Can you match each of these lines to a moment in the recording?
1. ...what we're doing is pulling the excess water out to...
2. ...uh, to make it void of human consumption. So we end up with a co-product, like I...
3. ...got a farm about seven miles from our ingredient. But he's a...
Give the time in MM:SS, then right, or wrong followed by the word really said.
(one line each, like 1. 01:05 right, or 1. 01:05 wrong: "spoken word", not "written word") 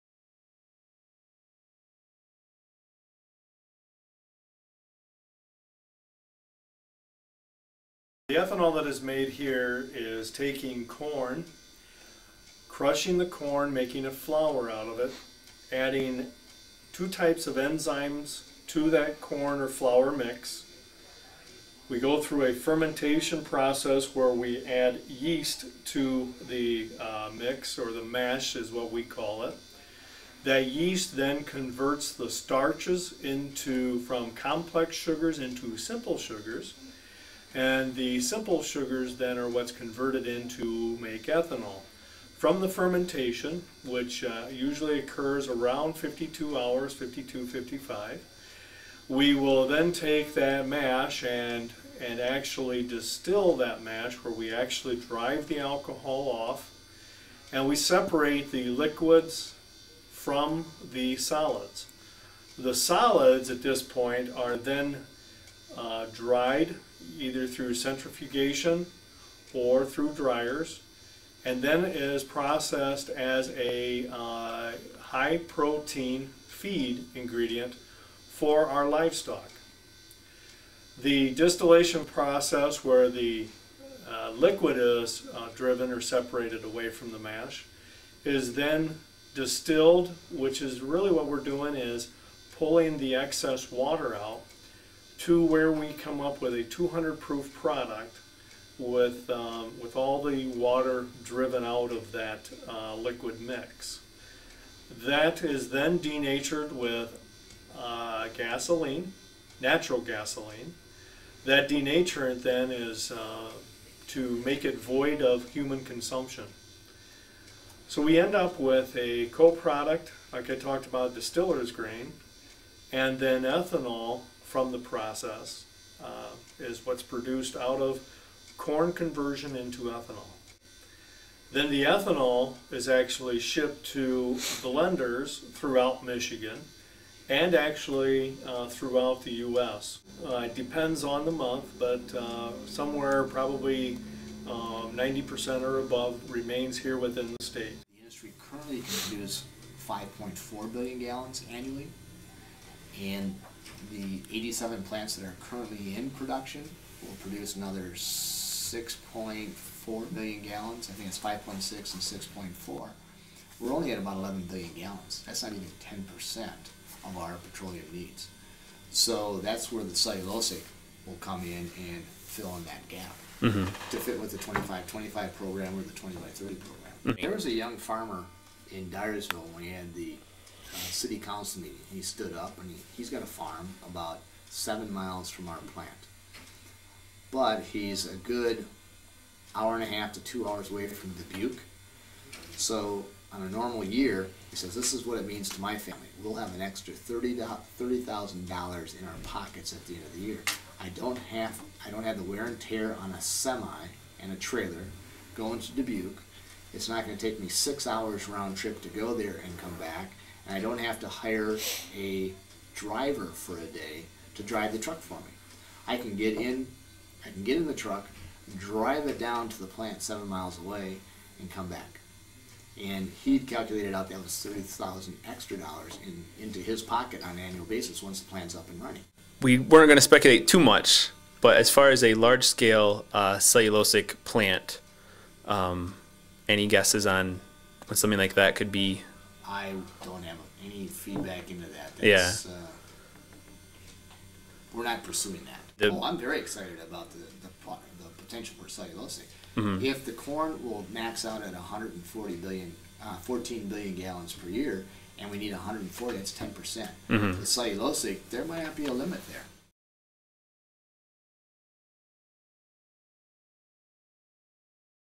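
1. 01:31 right
2. 01:53 right
3. 03:03 wrong: "plant", not "ingredient".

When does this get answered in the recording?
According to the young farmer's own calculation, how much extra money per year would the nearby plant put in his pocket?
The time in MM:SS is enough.
03:16.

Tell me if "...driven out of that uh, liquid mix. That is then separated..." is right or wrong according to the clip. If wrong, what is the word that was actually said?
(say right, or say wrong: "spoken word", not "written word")
wrong: "denatured", not "separated".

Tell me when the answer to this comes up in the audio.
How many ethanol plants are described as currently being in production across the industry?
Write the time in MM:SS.
02:34.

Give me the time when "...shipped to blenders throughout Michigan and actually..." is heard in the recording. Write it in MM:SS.
02:13.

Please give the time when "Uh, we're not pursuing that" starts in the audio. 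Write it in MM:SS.
04:02.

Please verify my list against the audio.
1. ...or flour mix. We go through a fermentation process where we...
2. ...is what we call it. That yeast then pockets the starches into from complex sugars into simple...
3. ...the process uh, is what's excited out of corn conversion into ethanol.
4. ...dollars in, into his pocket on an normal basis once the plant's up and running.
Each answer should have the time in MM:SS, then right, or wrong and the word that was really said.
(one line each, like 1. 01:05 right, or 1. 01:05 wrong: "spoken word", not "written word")
1. 00:19 right
2. 00:28 wrong: "converts", not "pockets"
3. 02:04 wrong: "produced", not "excited"
4. 03:45 wrong: "annual", not "normal".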